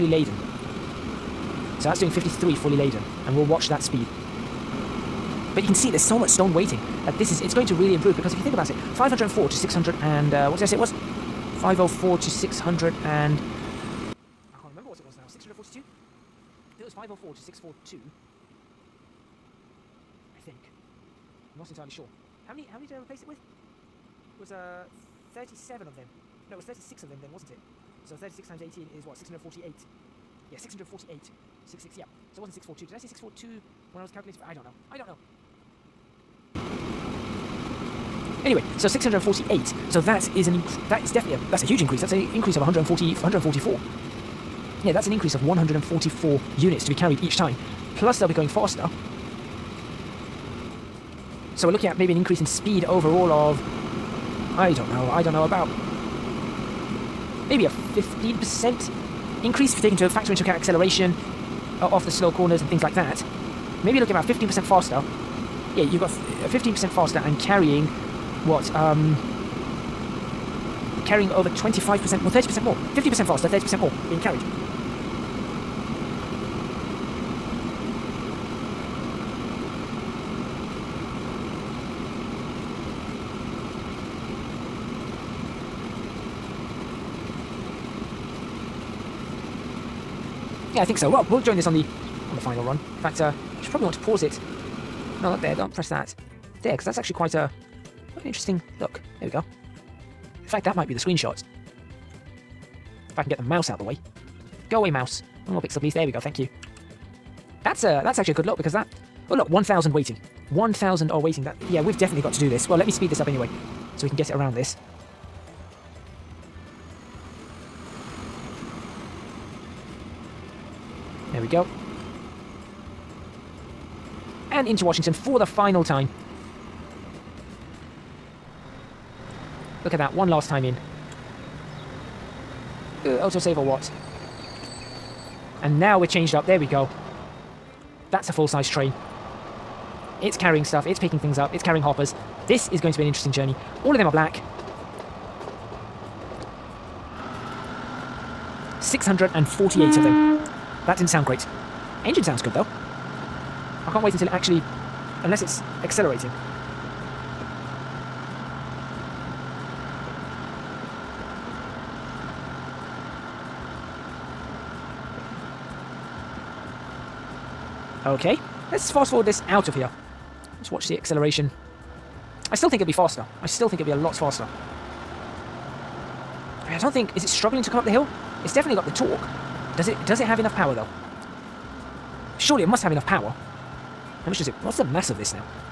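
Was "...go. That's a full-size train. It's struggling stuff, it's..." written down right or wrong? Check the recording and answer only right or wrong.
wrong.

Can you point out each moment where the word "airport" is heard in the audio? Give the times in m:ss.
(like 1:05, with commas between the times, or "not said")
not said.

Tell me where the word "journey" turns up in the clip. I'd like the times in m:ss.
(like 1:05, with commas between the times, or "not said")
2:23.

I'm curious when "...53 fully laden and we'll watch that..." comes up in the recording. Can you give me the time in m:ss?
0:02.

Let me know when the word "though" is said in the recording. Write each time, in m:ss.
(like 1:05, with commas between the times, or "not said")
2:32, 3:00.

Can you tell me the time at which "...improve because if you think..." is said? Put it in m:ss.
0:07.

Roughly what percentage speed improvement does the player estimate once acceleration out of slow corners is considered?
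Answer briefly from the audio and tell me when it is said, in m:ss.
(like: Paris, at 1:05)
15%, at 0:57.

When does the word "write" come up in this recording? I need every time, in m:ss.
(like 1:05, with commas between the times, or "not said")
not said.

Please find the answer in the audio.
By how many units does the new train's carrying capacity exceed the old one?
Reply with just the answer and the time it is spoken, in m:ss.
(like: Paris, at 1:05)
144, at 0:45.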